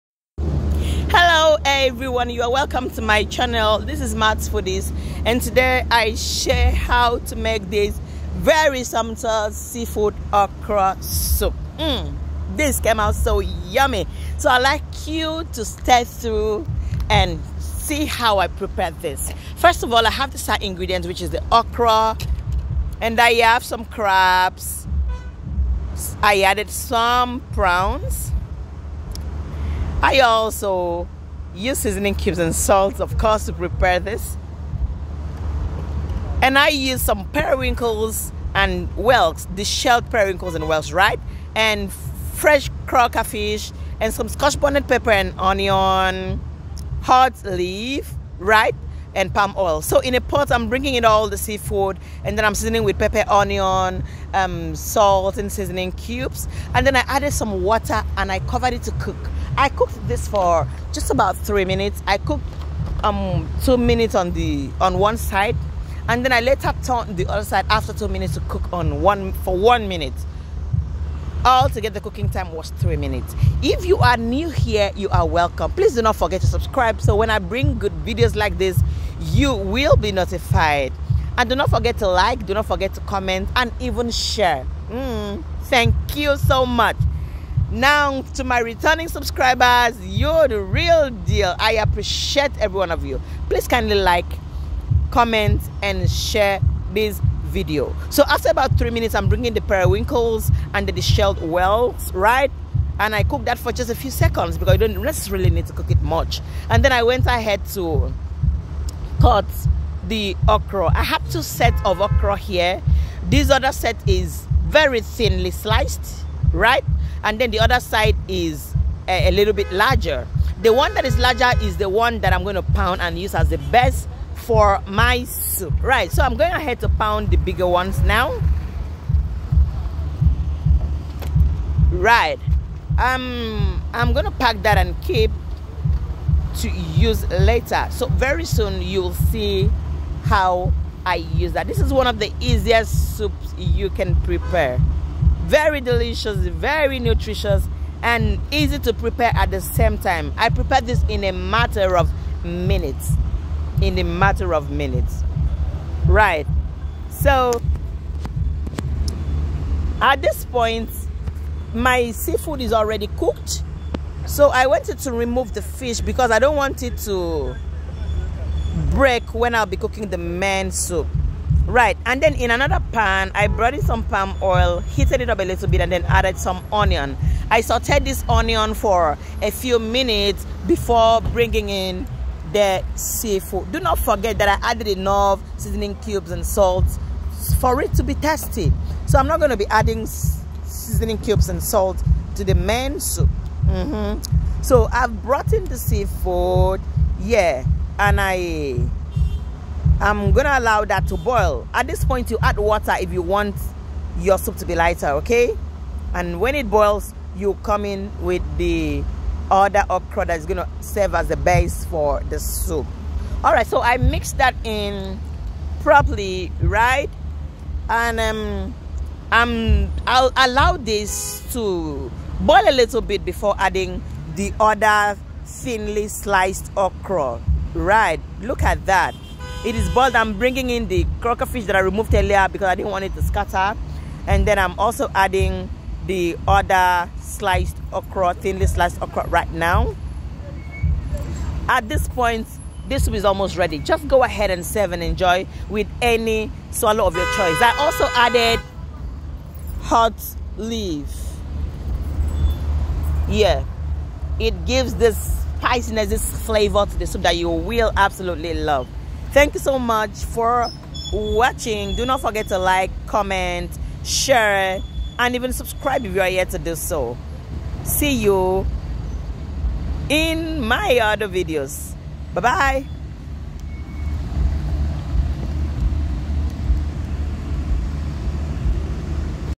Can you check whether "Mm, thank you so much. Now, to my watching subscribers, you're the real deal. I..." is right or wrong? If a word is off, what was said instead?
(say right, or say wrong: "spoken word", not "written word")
wrong: "returning", not "watching".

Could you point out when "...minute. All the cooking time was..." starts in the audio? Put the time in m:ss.
1:09.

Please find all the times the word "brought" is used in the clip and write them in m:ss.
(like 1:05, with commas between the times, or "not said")
2:53, 3:15.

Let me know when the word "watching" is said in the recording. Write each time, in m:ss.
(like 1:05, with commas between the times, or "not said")
4:21.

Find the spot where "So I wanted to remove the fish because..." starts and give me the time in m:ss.
2:44.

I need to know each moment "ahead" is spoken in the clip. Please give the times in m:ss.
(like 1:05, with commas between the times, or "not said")
1:47, 2:06, 4:04.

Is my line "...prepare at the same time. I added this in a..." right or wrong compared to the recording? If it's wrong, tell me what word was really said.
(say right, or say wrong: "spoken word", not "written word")
wrong: "prepared", not "added".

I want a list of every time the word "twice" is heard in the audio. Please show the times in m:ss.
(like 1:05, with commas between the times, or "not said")
not said.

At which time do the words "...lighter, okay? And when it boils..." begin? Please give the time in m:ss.
3:24.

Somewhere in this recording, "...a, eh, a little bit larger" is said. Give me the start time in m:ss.
1:59.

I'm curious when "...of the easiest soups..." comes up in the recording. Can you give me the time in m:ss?
2:22.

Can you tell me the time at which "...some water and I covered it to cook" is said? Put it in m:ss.
0:57.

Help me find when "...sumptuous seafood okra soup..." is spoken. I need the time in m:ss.
0:08.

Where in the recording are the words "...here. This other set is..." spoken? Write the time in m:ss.
1:52.